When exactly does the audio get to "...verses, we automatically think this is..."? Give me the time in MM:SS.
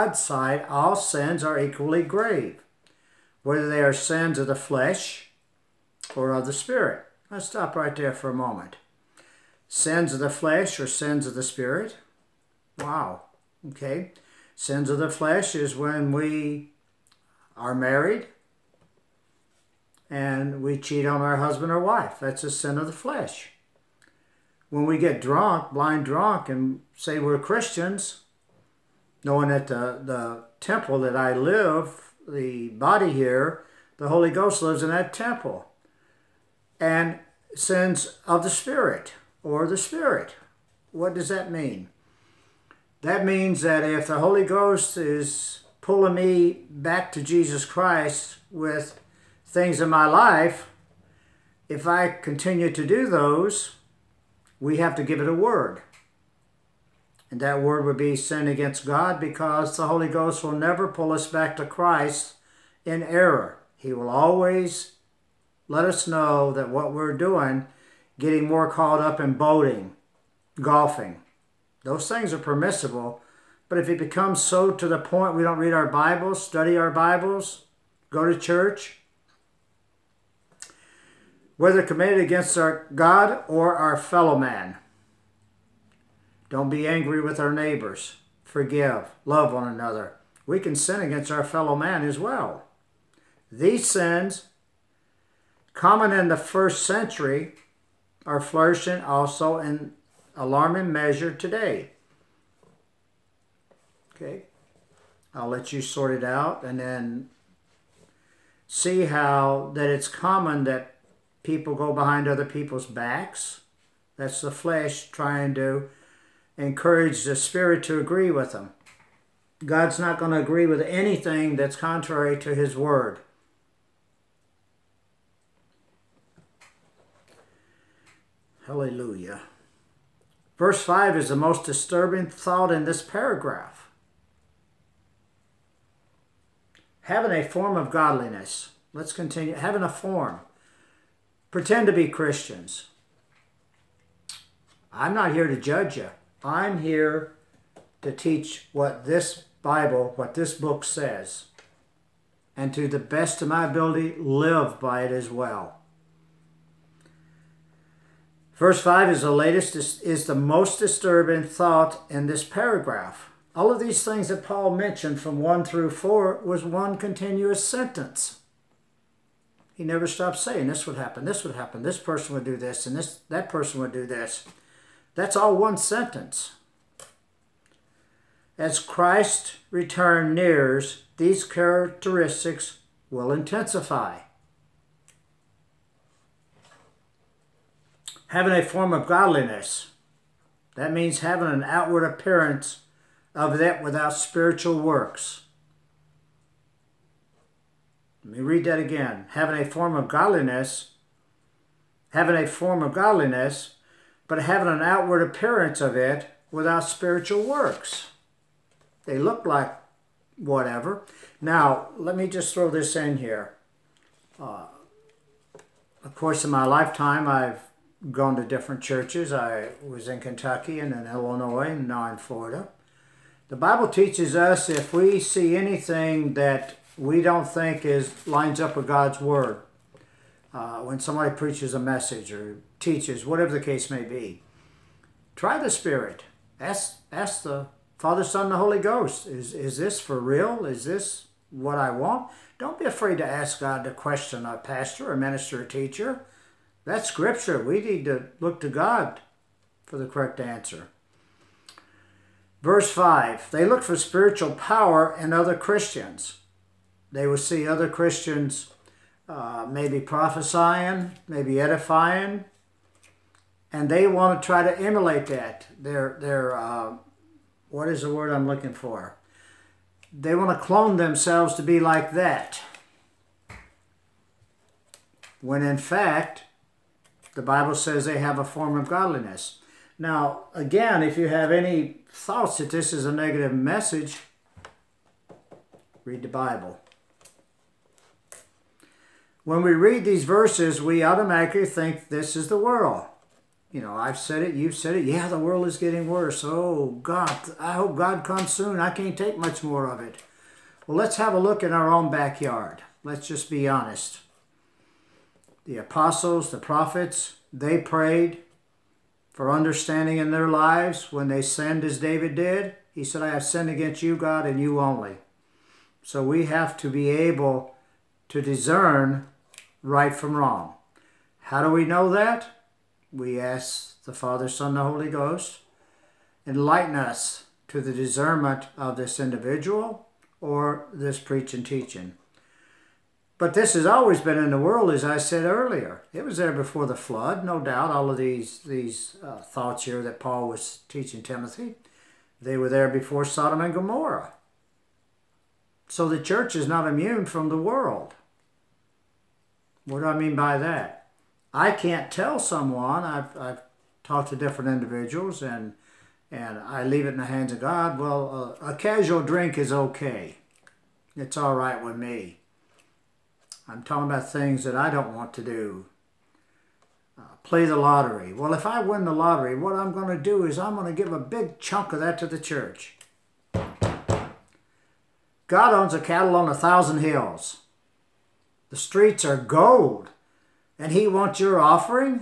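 04:50.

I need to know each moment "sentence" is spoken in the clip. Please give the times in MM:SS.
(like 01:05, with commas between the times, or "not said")
02:47, 02:55.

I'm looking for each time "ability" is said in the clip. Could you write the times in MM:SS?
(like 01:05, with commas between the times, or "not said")
02:33.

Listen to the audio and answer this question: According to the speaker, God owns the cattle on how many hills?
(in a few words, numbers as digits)
1000.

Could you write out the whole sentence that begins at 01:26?
Don't be angry with our neighbors.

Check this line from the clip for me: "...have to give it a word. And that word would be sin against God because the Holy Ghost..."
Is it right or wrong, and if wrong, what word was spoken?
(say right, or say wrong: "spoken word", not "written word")
right.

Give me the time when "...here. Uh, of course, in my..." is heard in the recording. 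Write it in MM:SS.
03:33.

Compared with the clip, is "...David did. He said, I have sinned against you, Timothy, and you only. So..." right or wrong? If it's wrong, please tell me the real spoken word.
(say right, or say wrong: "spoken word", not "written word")
wrong: "God", not "Timothy".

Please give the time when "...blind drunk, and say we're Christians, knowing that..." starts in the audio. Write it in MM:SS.
00:25.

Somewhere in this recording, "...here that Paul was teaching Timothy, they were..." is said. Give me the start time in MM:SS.
05:39.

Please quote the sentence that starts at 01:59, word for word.
God's not going to agree with anything that's contrary to his word.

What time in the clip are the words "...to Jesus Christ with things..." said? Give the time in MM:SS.
00:47.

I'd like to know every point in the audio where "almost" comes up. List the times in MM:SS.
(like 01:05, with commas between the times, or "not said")
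not said.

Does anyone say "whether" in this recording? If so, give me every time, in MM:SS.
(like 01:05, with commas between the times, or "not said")
00:03, 01:21.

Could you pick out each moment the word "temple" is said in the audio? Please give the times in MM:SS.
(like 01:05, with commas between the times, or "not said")
00:30, 00:35.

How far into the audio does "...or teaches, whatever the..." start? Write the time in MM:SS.
03:52.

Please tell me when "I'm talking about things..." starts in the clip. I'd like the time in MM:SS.
06:03.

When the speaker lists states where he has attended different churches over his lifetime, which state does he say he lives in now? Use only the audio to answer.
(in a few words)
Florida.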